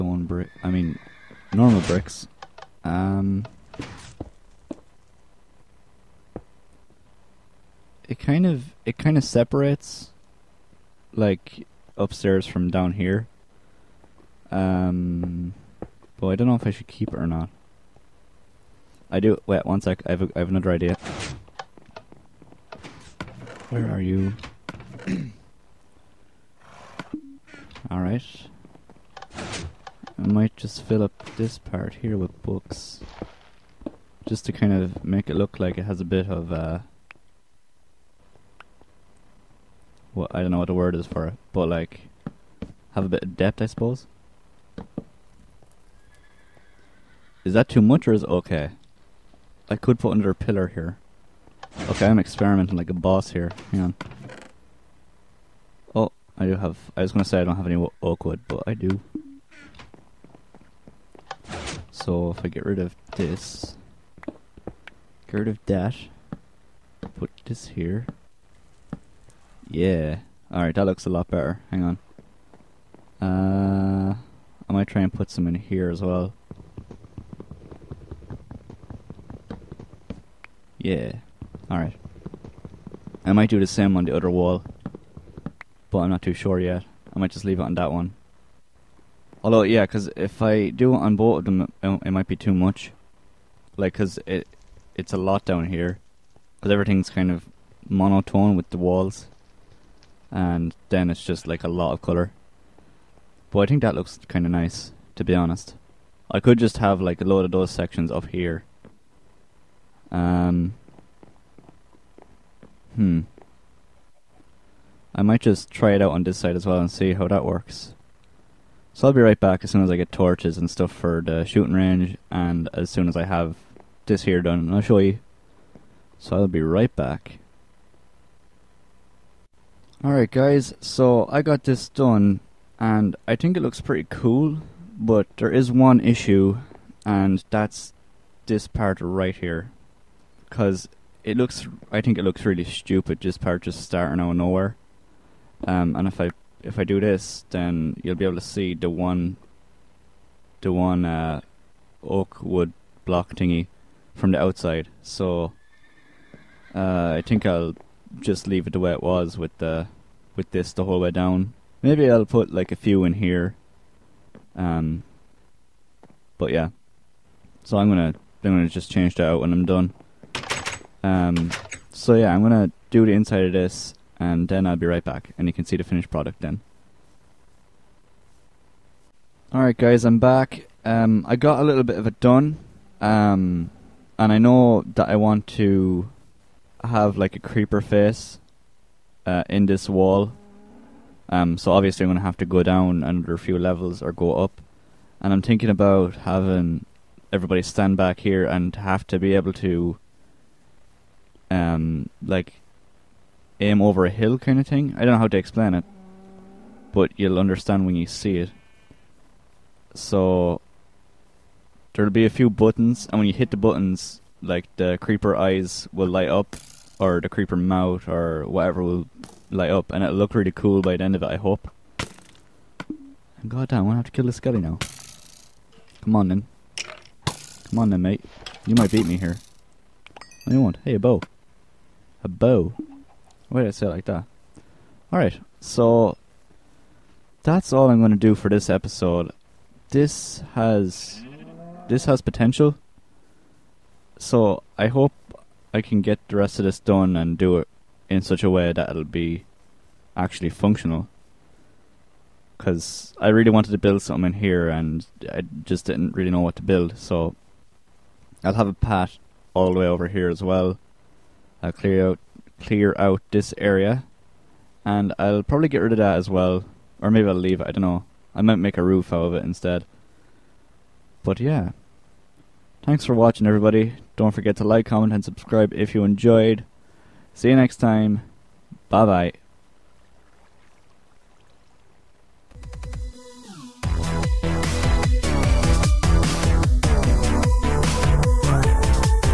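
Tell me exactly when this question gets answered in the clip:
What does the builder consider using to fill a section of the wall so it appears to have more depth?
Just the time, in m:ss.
0:32.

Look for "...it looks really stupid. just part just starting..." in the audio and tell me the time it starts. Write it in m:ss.
2:22.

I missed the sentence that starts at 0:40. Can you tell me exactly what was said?
Well, I don't know what the word is for it, but like...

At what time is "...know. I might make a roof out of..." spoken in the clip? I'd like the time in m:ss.
4:27.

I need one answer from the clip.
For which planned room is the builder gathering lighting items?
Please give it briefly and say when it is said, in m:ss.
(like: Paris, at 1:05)
Shooting range, at 2:01.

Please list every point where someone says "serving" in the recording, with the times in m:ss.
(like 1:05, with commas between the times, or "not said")
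not said.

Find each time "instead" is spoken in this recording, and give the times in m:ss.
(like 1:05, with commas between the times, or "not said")
4:29.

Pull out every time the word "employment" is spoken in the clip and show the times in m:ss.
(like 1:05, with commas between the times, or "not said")
not said.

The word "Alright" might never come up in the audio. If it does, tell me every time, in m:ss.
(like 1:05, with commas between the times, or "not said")
0:27, 1:10, 1:21, 2:10, 2:59, 3:55.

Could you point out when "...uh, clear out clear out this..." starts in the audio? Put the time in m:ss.
4:21.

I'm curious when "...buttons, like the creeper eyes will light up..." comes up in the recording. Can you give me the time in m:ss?
3:33.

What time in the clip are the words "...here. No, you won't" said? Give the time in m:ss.
3:49.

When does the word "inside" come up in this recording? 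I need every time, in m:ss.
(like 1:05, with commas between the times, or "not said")
2:53.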